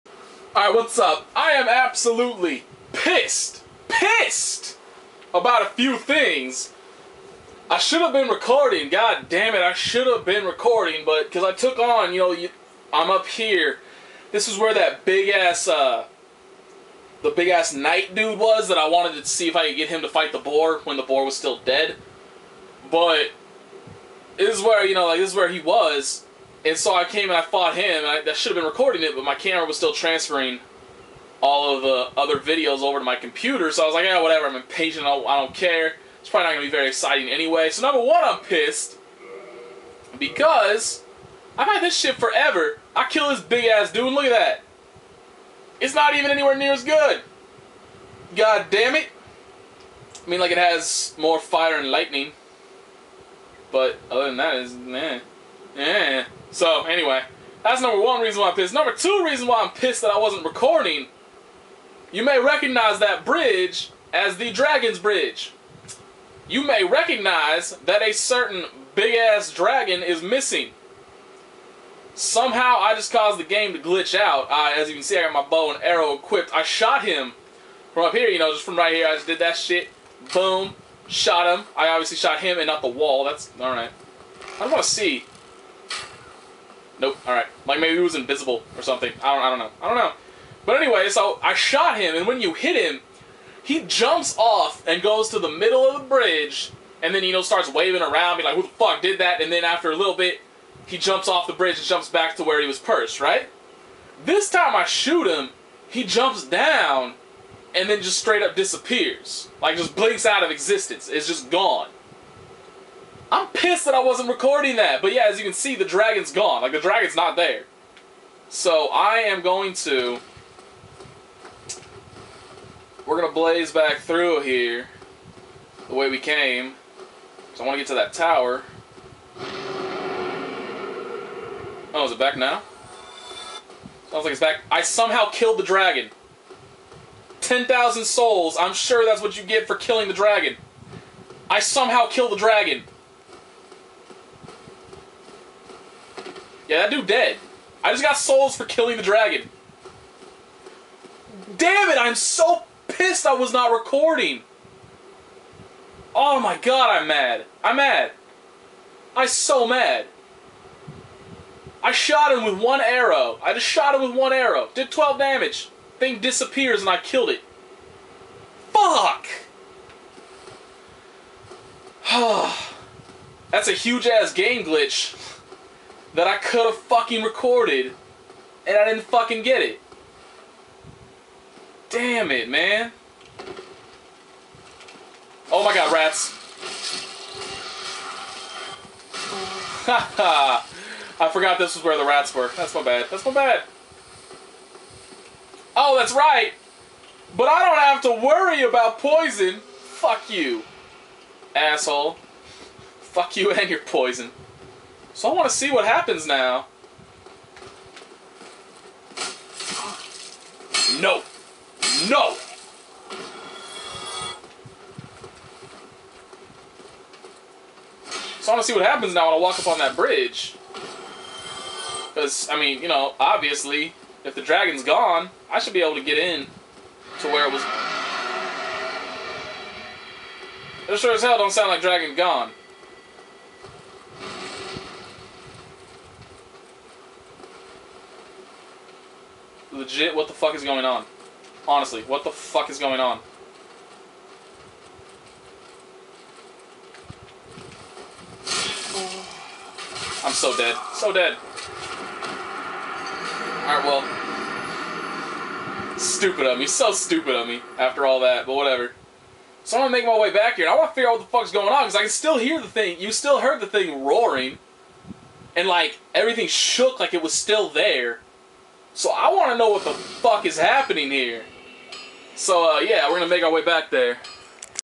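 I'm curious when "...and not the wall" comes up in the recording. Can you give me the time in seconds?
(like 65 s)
82 s.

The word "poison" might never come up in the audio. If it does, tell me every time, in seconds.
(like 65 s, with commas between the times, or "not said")
198 s, 203 s.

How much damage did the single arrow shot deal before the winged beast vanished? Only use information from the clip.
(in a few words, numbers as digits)
12.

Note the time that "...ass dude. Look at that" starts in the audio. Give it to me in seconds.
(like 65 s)
43 s.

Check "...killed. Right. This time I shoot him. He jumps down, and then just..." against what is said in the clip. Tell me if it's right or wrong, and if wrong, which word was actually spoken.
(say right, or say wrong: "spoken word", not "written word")
wrong: "perched", not "killed".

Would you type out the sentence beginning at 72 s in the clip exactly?
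Somehow I just caused the game to glitch out.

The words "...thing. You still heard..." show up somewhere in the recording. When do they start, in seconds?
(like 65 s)
262 s.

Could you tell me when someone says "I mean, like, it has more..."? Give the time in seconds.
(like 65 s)
50 s.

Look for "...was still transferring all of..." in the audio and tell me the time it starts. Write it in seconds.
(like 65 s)
29 s.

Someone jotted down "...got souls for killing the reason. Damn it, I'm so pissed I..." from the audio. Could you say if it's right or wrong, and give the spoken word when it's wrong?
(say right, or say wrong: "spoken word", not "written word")
wrong: "dragon", not "reason".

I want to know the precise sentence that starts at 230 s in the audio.
It sure as hell don't sound like Dragon Gone.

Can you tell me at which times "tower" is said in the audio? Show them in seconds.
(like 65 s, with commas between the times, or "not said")
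128 s.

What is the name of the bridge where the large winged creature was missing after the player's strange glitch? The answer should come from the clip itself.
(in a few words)
Dragon's Bridge.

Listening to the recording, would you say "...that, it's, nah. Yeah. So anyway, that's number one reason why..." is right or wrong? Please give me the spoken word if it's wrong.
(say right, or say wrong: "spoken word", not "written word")
right.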